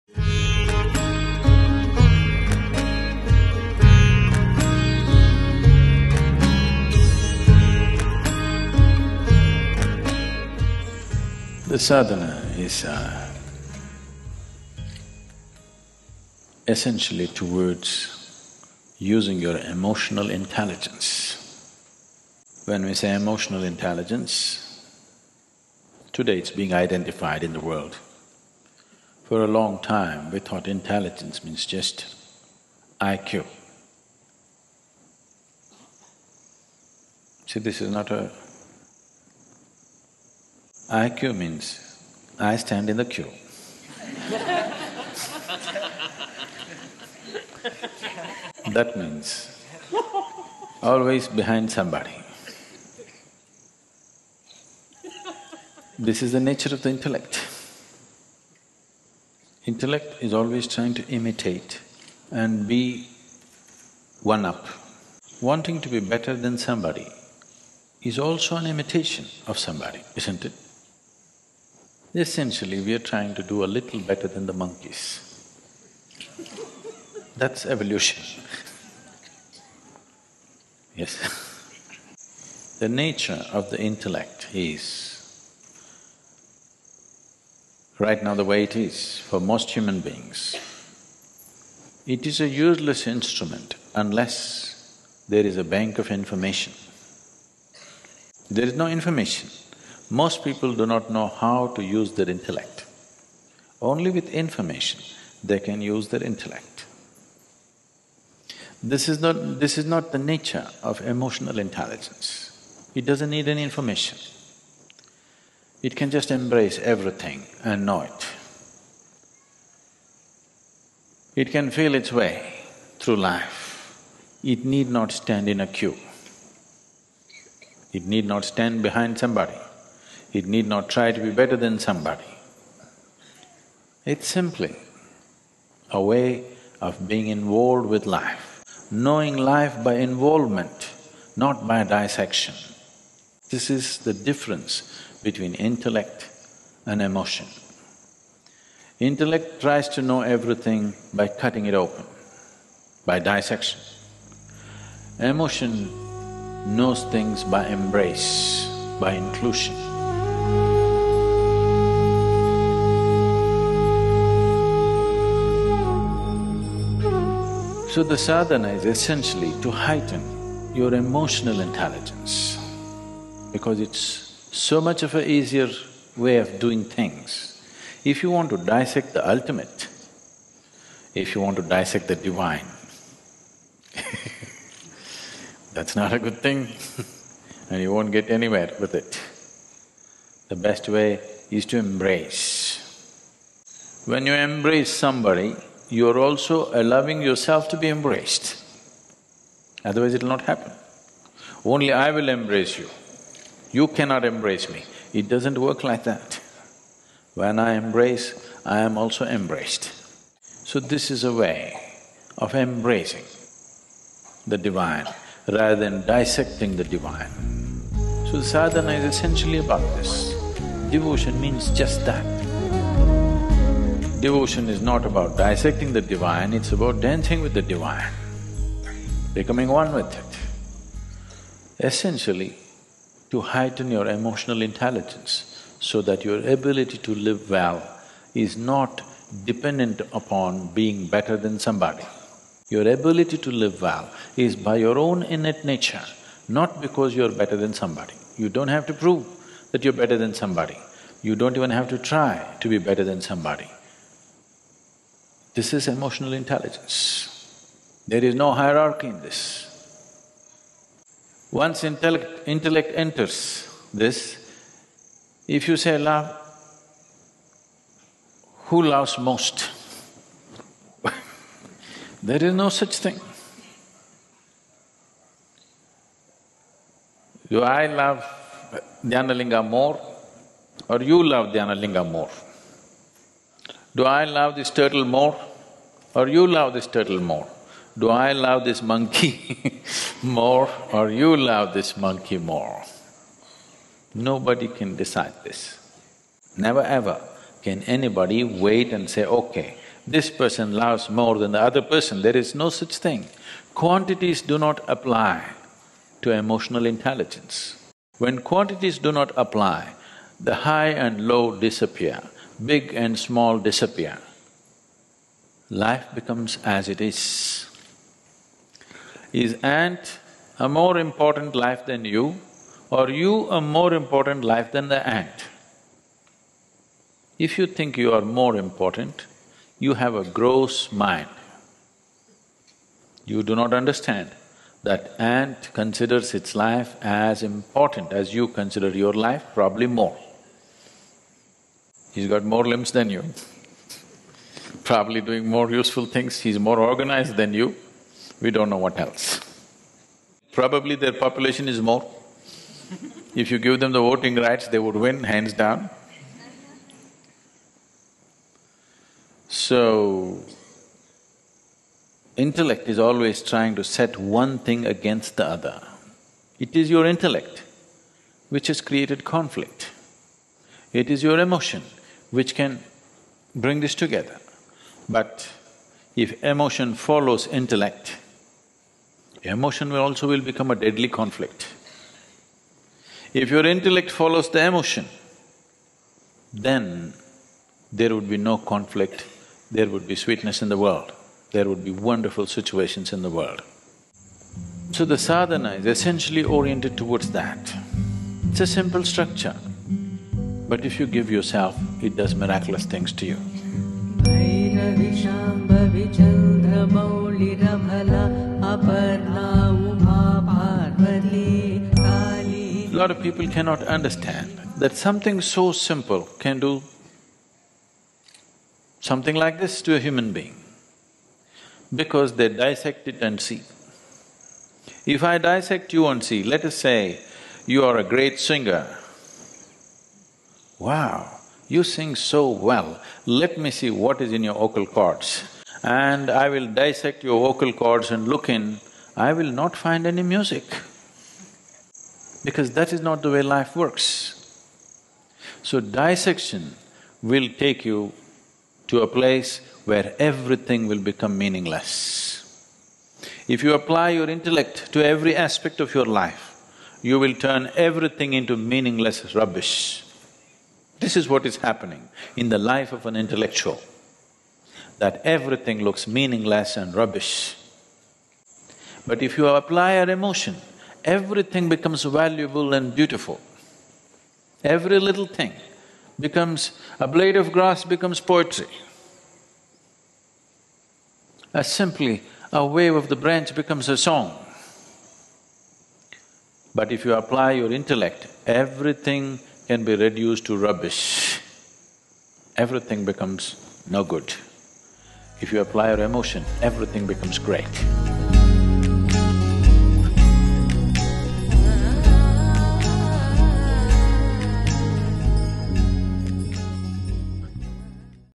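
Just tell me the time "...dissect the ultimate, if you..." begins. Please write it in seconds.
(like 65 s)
178 s.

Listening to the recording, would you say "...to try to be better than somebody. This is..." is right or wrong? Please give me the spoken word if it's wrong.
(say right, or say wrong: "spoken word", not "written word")
right.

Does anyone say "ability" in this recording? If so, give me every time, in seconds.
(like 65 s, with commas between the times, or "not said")
236 s, 242 s.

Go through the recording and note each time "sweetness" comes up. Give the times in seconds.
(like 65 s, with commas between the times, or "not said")
390 s.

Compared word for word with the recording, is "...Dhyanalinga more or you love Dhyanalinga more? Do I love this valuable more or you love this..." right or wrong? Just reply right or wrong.
wrong.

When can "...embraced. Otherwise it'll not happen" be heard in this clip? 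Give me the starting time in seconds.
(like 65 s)
197 s.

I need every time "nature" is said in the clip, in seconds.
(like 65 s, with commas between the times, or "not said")
56 s, 82 s, 110 s, 245 s.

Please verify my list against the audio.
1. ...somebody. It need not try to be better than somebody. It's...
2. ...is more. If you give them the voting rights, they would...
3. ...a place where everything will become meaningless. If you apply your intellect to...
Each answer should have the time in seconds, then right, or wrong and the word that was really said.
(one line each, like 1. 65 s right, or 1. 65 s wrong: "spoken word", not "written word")
1. 129 s right
2. 351 s right
3. 449 s right.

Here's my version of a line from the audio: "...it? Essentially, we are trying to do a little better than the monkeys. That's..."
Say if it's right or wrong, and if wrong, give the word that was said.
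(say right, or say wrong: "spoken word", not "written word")
right.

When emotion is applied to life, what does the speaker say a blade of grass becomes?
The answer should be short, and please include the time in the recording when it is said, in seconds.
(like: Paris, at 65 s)
Poetry, at 478 s.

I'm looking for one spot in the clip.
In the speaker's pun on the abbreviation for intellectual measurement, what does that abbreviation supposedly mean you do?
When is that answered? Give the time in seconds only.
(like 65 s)
42 s.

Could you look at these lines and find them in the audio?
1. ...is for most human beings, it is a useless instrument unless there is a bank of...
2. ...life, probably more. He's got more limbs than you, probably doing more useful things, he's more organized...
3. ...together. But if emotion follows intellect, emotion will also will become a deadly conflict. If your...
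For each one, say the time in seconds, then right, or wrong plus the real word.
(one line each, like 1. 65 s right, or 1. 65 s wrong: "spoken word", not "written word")
1. 88 s right
2. 339 s right
3. 373 s right.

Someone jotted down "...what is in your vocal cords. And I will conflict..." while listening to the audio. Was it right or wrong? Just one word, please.
wrong.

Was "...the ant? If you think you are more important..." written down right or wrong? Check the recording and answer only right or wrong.
right.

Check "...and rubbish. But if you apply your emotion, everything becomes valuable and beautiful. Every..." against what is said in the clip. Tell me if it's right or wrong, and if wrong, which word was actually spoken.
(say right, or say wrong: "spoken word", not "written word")
right.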